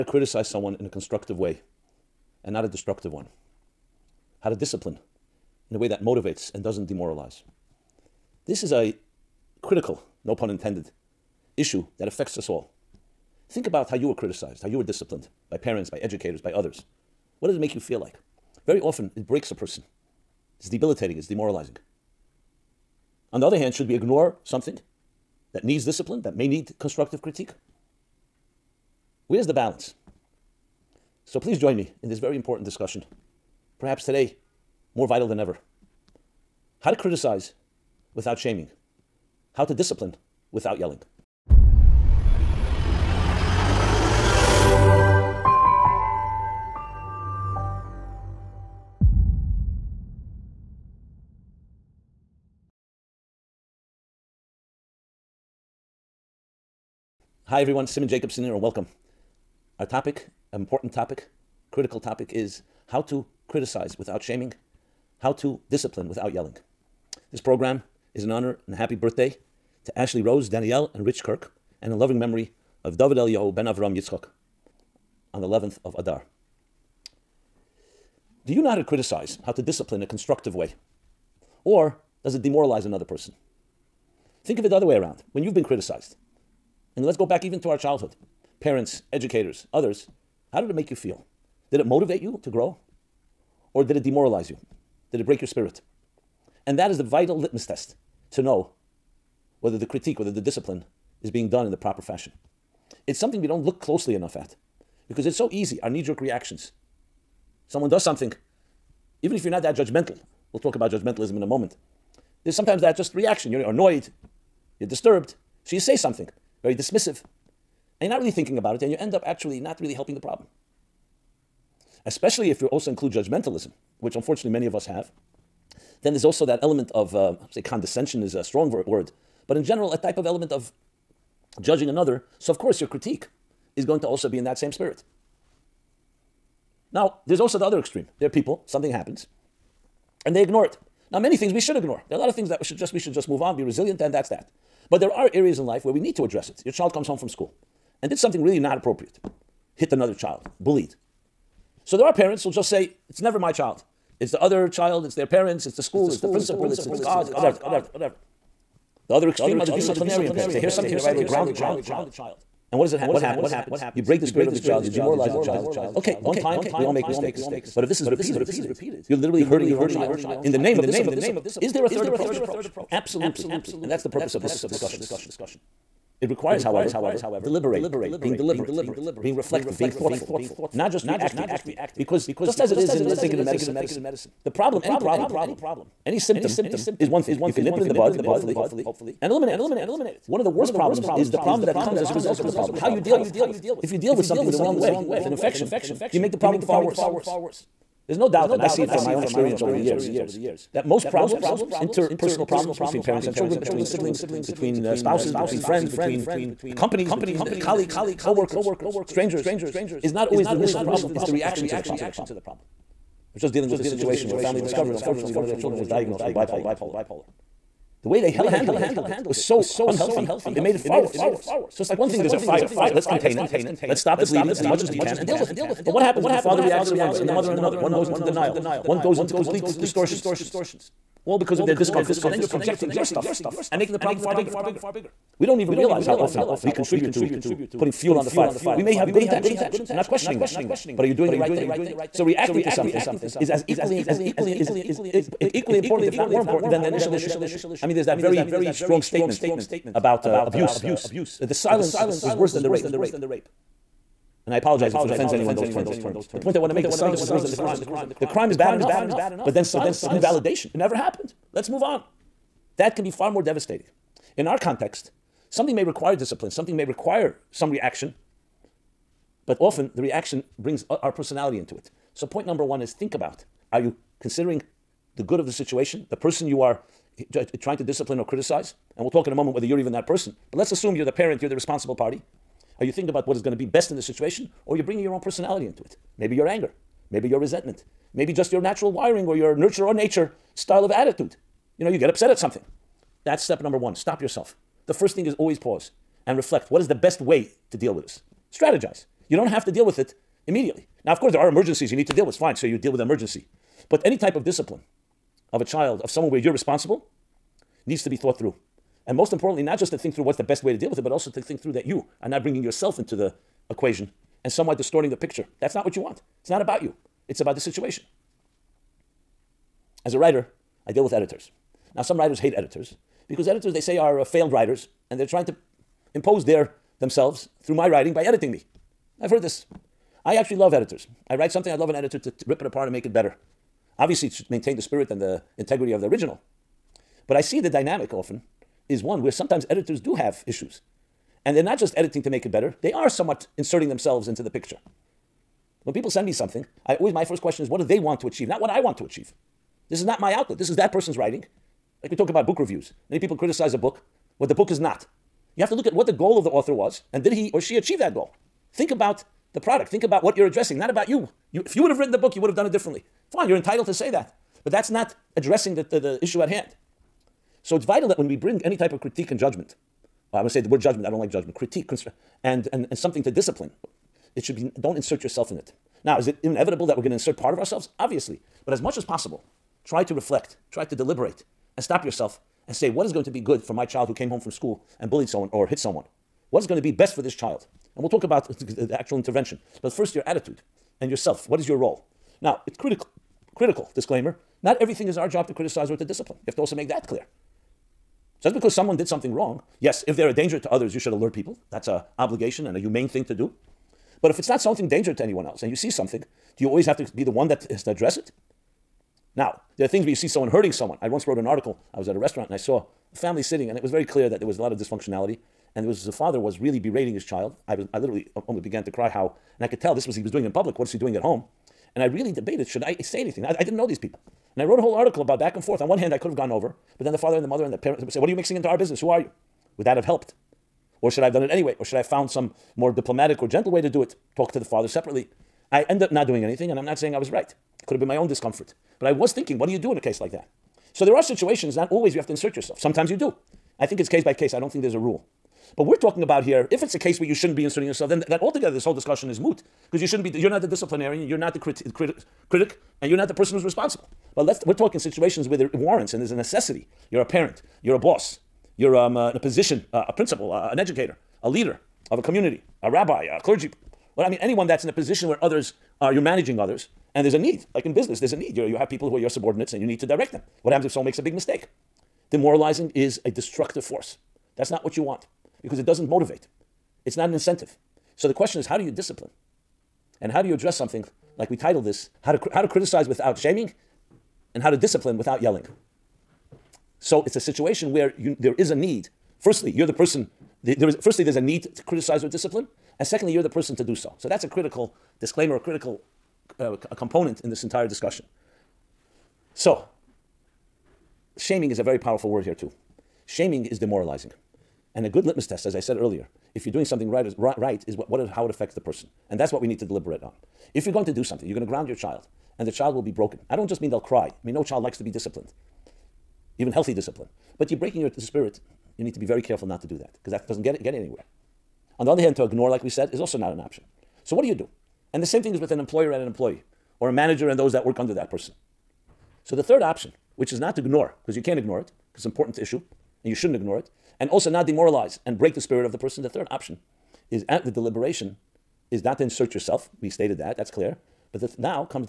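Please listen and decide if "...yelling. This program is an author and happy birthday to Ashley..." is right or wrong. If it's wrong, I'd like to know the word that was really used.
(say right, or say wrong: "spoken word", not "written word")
wrong: "honor", not "author".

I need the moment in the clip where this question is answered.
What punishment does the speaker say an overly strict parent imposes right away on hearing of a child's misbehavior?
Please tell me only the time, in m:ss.
2:41.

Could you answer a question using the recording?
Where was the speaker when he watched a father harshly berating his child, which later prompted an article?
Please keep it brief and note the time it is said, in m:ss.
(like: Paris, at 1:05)
a restaurant, at 6:52.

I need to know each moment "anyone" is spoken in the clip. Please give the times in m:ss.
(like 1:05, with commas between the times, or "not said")
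4:15, 6:45, 7:44.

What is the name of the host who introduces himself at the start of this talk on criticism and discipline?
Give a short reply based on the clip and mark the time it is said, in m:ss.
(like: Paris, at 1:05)
Simon Jacobson, at 0:57.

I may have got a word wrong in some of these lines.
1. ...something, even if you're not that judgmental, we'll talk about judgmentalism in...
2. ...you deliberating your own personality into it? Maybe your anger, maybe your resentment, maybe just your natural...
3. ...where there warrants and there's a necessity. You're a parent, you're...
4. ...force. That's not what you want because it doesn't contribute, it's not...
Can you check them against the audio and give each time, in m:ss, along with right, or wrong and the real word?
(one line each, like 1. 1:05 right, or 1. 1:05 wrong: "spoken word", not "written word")
1. 1:48 right
2. 4:44 wrong: "bringing", not "deliberating"
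3. 7:35 right
4. 7:53 wrong: "motivate", not "contribute".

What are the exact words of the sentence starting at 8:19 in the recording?
So shaming is a very powerful word here too.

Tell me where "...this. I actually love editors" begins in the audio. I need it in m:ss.
5:29.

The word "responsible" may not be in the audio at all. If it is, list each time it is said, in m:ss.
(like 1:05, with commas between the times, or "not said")
4:41, 5:06, 7:33.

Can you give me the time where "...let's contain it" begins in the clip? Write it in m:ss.
3:42.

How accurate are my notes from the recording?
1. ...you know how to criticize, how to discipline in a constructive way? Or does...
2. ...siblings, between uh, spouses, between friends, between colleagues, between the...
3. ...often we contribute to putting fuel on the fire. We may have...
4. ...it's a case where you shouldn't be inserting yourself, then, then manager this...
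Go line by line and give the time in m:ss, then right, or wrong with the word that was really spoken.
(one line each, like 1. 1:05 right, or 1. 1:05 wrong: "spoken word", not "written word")
1. 1:18 right
2. 3:23 wrong: "companies", not "colleagues"
3. 3:56 right
4. 7:26 wrong: "altogether", not "manager".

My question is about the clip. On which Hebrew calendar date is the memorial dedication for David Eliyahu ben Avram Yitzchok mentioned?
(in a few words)
11th of Adar.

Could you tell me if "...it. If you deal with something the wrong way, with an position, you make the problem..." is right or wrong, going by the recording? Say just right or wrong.
wrong.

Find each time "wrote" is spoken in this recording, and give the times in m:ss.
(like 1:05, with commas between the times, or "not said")
6:51, 7:04.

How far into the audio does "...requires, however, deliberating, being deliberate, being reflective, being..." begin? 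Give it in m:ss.
2:56.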